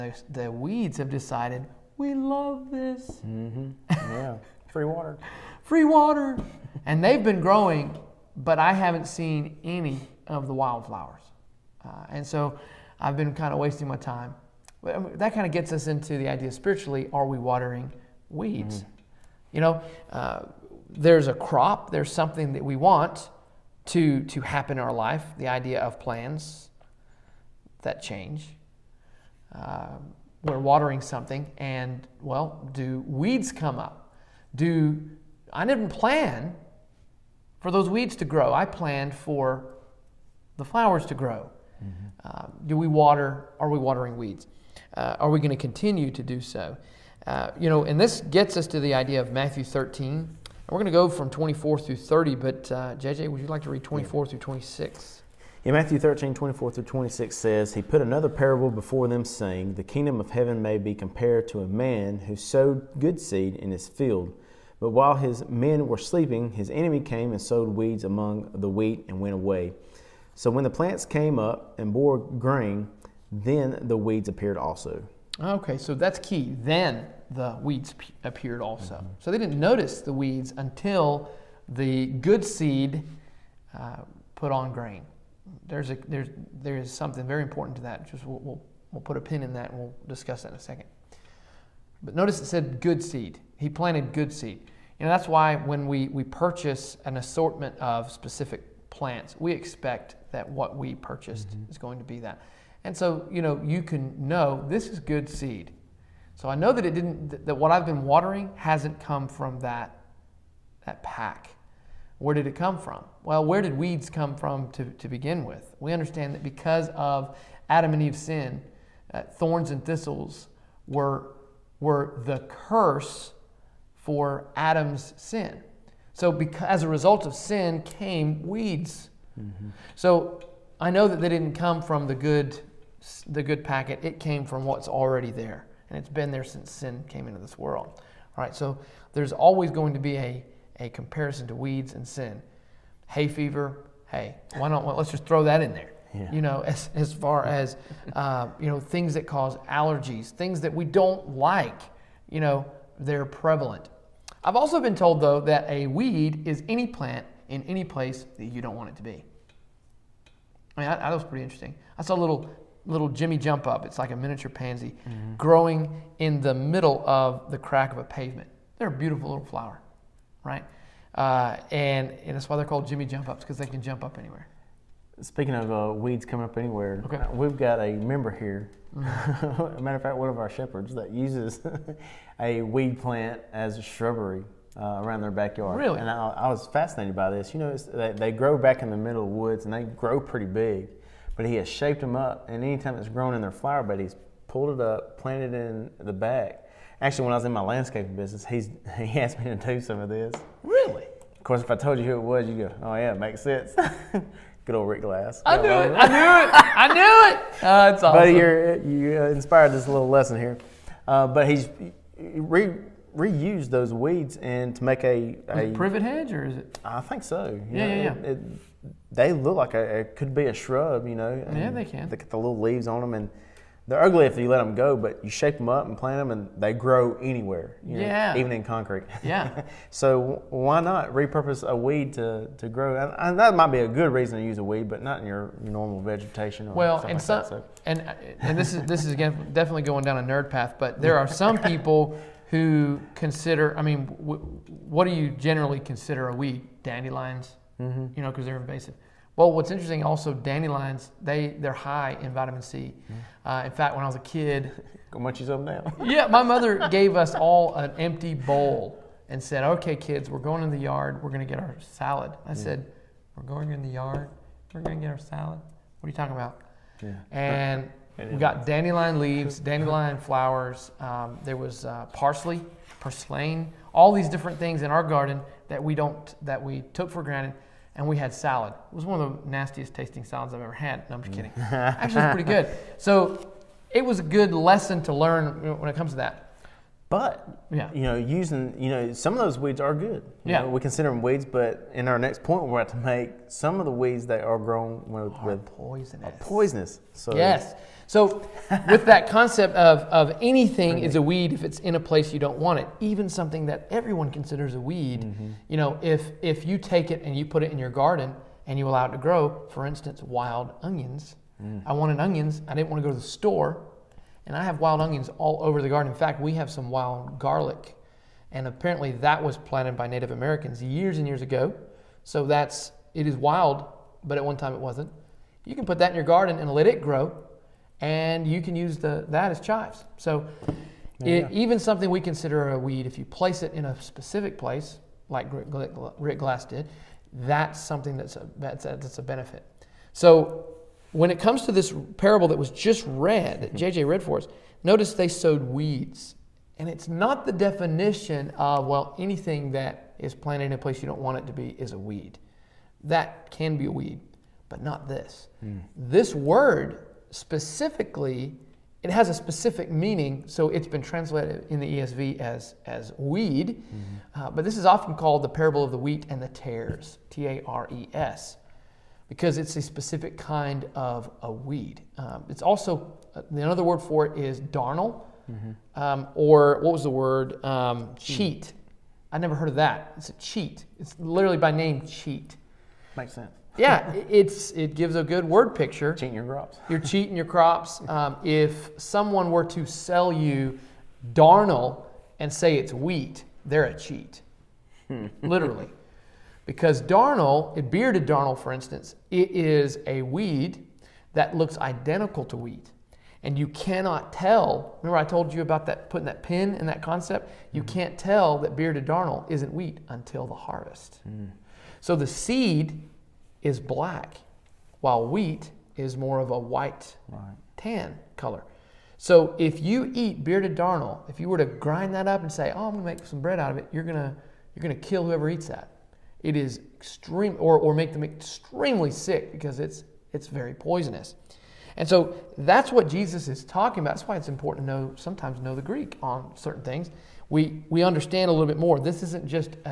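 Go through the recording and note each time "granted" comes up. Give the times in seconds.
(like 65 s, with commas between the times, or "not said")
277 s.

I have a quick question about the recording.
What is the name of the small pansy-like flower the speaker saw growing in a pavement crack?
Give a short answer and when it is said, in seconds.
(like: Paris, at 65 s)
Jimmy jump up, at 163 s.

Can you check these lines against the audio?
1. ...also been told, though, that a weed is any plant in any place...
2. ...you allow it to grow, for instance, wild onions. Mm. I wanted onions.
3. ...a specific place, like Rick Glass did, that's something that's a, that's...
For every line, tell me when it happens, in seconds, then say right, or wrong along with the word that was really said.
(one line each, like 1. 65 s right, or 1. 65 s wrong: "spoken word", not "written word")
1. 154 s right
2. 308 s right
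3. 333 s right.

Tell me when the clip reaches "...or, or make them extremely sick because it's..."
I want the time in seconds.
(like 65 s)
427 s.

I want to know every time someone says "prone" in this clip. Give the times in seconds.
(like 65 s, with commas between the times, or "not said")
not said.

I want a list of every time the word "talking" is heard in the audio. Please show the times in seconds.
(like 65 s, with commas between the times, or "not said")
266 s, 433 s.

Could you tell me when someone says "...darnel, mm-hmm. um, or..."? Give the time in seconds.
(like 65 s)
374 s.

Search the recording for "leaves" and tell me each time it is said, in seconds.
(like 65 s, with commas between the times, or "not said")
222 s, 269 s.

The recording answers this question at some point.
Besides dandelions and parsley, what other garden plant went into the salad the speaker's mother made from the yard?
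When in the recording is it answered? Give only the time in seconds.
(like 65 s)
273 s.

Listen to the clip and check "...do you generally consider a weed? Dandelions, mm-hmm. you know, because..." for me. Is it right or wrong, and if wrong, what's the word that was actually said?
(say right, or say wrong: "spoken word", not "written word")
right.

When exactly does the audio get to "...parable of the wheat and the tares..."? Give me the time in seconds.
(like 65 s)
365 s.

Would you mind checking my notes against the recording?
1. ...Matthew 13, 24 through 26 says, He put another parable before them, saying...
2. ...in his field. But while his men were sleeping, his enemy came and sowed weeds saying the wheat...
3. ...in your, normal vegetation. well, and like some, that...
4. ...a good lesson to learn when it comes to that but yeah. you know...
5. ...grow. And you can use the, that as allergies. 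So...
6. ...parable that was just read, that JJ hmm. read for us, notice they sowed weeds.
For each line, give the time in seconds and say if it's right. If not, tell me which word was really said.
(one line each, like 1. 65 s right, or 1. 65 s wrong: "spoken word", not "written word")
1. 55 s right
2. 63 s wrong: "among", not "saying"
3. 235 s right
4. 284 s right
5. 327 s wrong: "chives", not "allergies"
6. 342 s right.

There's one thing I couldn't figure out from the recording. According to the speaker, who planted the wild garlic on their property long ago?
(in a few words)
Native Americans.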